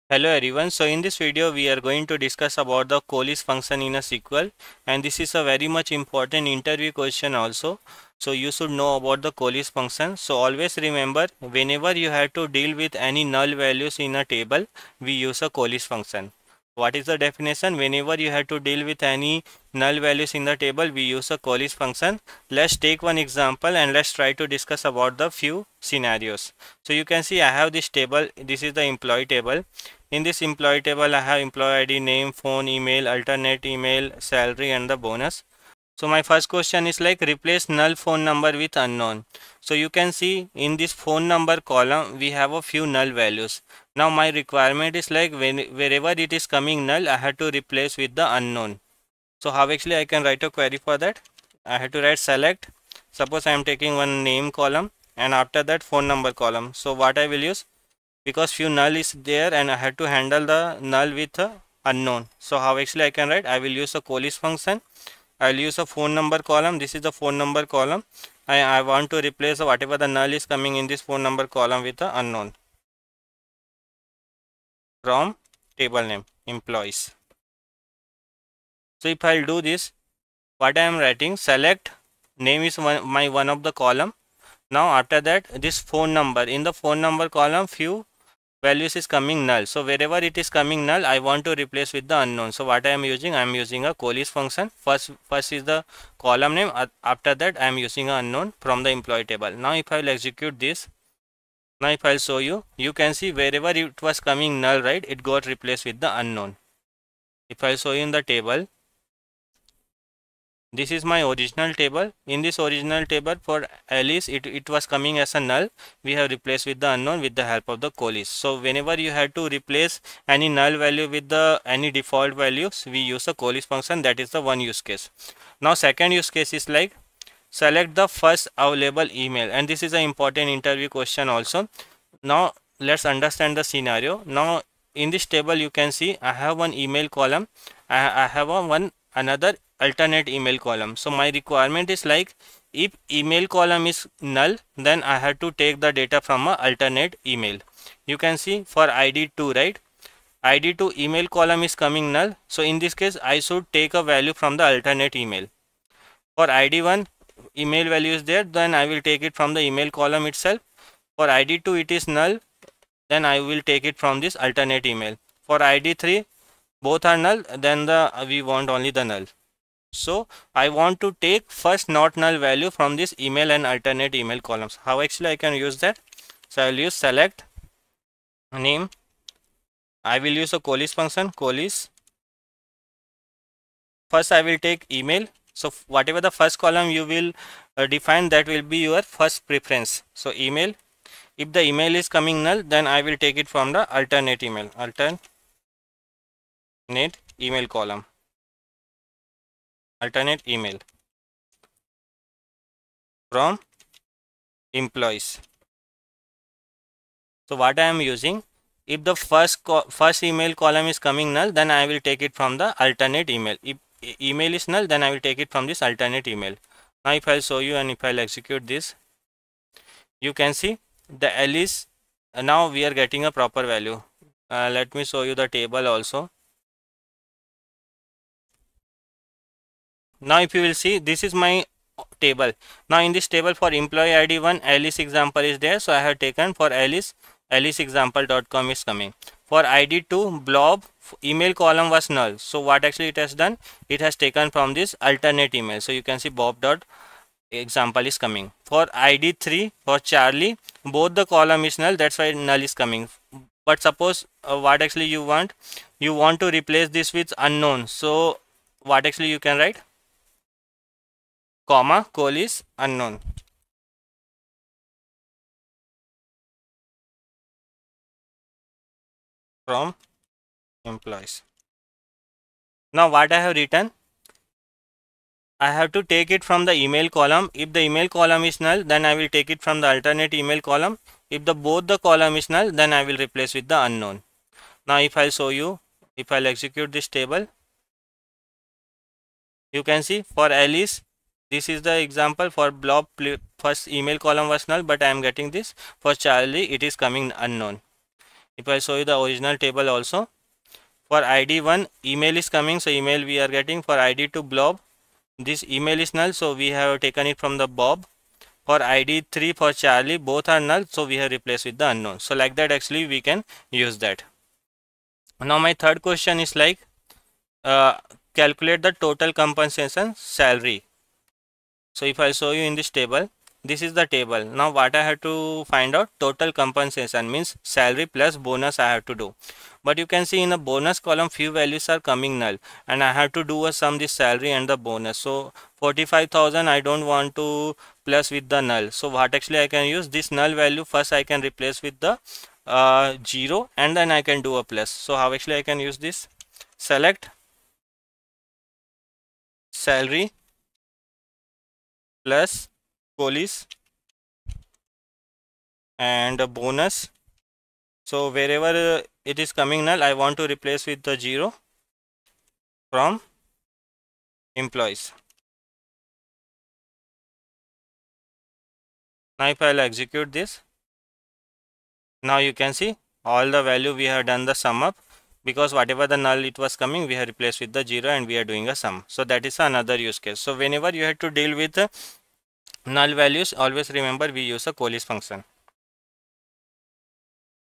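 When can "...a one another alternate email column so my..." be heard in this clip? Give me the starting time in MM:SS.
02:18.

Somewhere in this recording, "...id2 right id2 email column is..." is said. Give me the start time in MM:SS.
02:29.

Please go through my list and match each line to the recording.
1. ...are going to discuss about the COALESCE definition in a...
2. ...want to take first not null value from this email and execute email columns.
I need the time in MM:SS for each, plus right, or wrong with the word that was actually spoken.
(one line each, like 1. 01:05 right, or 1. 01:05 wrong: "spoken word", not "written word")
1. 00:01 wrong: "function", not "definition"
2. 02:50 wrong: "alternate", not "execute".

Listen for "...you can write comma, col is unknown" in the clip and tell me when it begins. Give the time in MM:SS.
04:19.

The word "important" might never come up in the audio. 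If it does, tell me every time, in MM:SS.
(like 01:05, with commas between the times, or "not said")
00:05, 02:10.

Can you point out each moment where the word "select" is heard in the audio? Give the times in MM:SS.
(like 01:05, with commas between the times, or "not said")
00:52, 01:21, 02:07, 02:56, 05:46.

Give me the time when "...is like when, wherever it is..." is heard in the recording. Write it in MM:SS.
00:44.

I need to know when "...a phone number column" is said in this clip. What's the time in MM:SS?
01:05.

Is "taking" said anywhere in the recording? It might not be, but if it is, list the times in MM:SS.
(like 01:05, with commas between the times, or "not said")
00:53.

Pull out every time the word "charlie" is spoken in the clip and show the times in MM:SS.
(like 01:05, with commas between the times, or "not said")
04:09, 04:56, 05:09.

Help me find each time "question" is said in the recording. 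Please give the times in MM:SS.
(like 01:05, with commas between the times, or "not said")
00:06, 00:36, 02:10, 05:16.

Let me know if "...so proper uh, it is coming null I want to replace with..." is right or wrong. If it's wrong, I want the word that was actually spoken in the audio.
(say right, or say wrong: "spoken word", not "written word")
wrong: "wherever", not "proper".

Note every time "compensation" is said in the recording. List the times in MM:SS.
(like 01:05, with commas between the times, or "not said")
05:19, 05:26.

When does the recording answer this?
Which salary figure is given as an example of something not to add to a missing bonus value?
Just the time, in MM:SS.
05:35.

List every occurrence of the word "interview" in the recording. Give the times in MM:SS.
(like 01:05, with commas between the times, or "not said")
00:06, 02:10.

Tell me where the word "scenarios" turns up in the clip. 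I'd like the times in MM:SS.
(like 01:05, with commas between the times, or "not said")
00:25, 02:13.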